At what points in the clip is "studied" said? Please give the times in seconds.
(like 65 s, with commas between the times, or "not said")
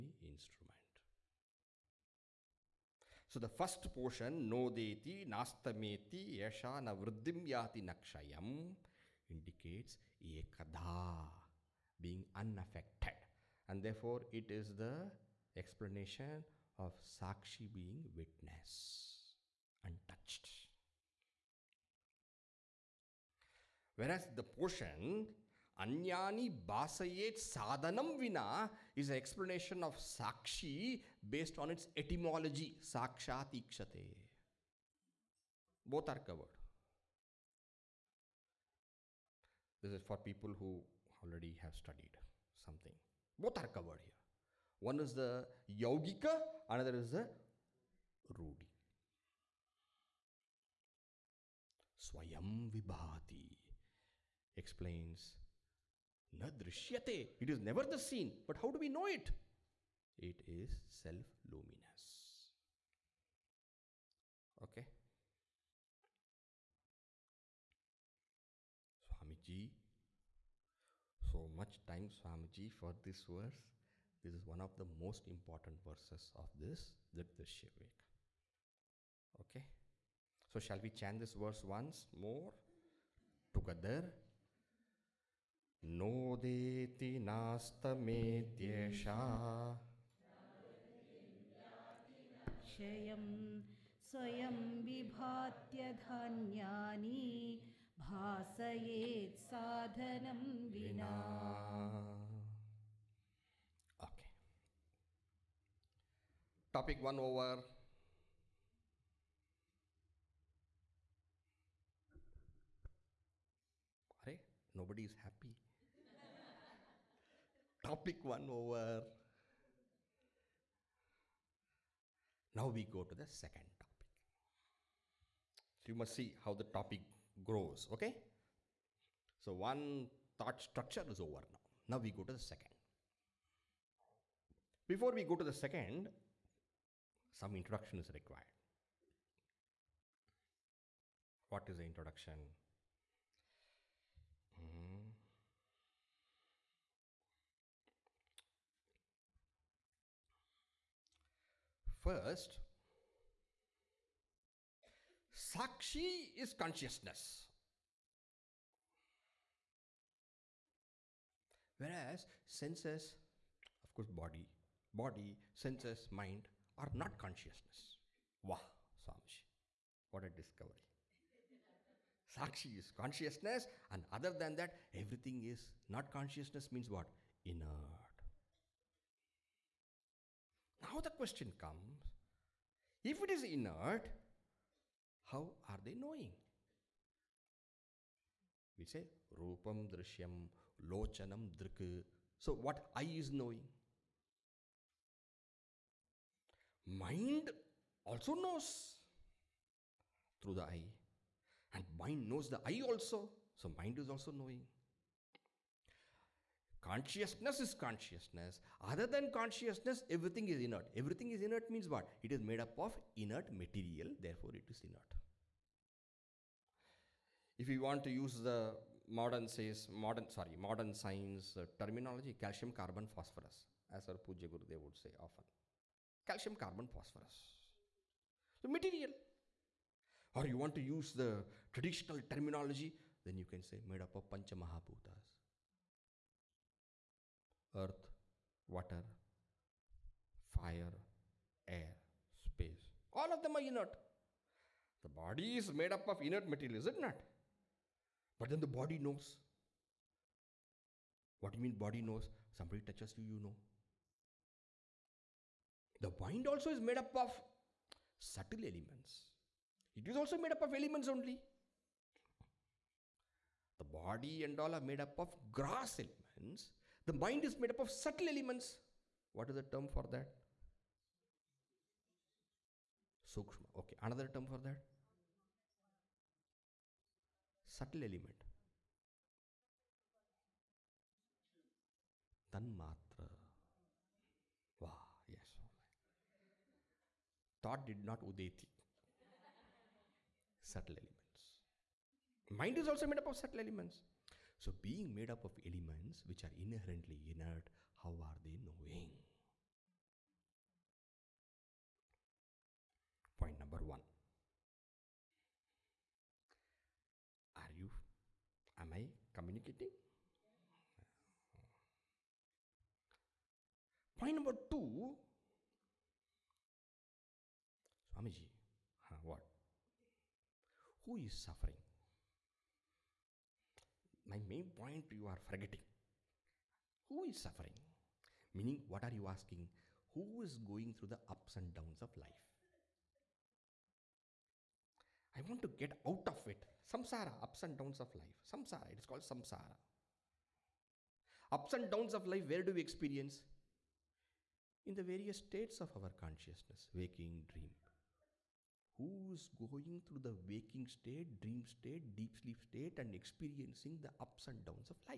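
41 s.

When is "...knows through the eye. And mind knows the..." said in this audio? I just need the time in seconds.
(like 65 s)
198 s.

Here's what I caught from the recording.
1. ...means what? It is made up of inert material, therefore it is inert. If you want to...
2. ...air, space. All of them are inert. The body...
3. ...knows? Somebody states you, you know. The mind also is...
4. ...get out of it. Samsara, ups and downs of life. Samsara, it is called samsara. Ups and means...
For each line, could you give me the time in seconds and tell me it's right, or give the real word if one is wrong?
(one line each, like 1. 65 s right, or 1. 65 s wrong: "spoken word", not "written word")
1. 211 s right
2. 241 s right
3. 252 s wrong: "touches", not "states"
4. 335 s wrong: "downs", not "means".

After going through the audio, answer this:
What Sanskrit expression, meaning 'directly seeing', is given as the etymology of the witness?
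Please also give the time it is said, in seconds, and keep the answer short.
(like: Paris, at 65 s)
Sakshat Ikshate, at 32 s.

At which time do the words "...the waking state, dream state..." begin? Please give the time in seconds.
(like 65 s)
350 s.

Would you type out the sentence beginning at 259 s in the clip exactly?
It is also made up of elements only.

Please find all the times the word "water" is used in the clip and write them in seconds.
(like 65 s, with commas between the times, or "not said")
238 s.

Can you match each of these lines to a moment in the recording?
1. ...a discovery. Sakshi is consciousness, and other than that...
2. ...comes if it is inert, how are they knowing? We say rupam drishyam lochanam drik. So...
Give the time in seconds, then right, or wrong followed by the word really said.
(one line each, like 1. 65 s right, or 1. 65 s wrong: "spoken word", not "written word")
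1. 170 s right
2. 181 s right.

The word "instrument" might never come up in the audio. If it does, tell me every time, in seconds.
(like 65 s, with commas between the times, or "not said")
0 s.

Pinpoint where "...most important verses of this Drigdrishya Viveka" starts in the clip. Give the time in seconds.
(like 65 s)
74 s.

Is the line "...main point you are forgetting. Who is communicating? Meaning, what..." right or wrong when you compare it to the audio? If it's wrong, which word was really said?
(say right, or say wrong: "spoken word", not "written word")
wrong: "suffering", not "communicating".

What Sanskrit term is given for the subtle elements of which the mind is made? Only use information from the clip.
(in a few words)
Tanmatra.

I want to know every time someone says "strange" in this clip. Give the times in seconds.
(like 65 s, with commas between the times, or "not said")
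not said.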